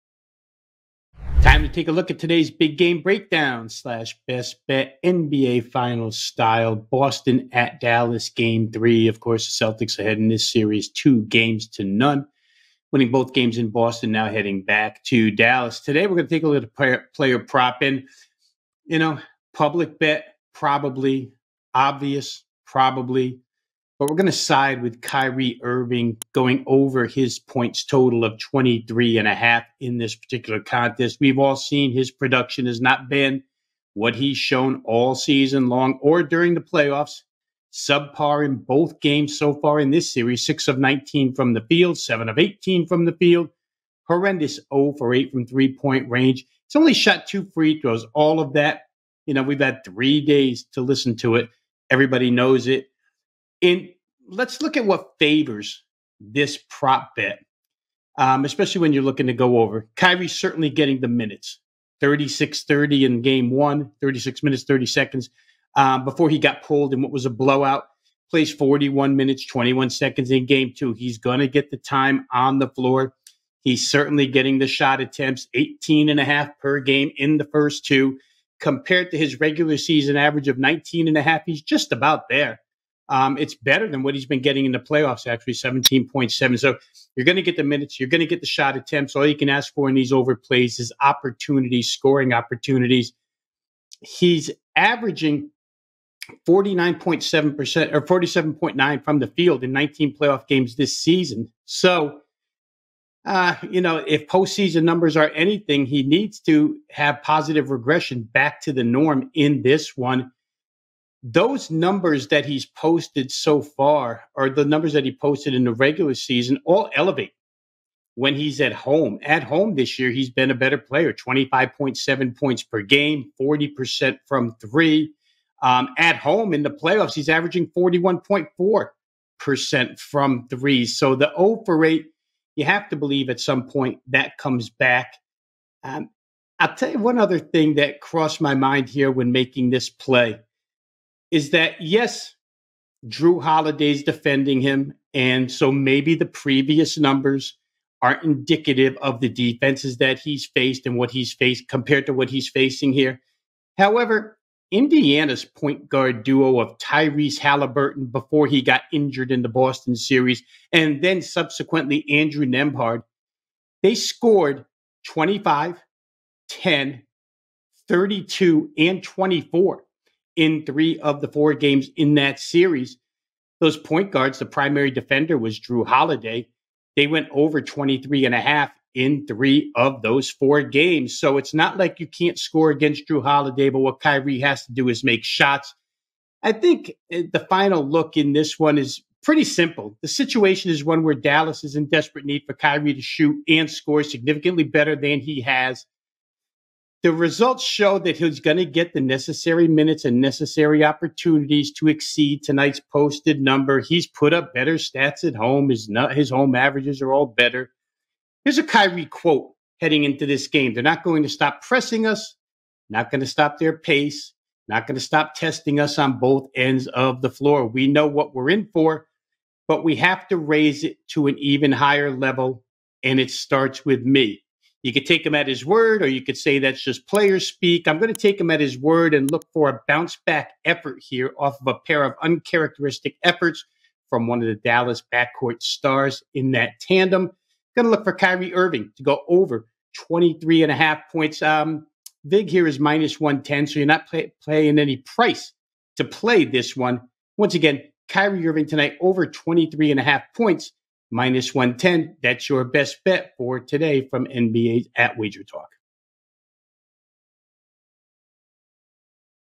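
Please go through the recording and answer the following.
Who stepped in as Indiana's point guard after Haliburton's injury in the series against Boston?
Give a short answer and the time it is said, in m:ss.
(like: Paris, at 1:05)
Andrew Nembhard, at 2:42.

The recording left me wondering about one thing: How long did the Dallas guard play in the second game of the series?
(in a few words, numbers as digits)
41 minutes, 21 seconds.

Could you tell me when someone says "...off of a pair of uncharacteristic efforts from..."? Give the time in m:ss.
3:51.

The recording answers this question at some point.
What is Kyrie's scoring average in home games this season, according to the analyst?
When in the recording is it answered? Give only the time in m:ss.
2:01.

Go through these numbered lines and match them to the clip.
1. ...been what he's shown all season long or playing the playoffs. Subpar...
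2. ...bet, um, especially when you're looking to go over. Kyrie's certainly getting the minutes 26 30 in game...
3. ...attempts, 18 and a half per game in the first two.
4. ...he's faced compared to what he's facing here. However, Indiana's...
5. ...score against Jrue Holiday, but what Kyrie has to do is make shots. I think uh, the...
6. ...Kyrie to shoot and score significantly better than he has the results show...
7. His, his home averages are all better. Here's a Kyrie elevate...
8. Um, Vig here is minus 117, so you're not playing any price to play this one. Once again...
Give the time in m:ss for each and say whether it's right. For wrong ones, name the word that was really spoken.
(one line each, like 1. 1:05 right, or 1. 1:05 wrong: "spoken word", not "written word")
1. 0:33 wrong: "during", not "playing"
2. 0:57 wrong: "36", not "26"
3. 1:15 right
4. 2:31 right
5. 3:02 right
6. 3:12 right
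7. 3:25 wrong: "quote", not "elevate"
8. 4:01 wrong: "110", not "117".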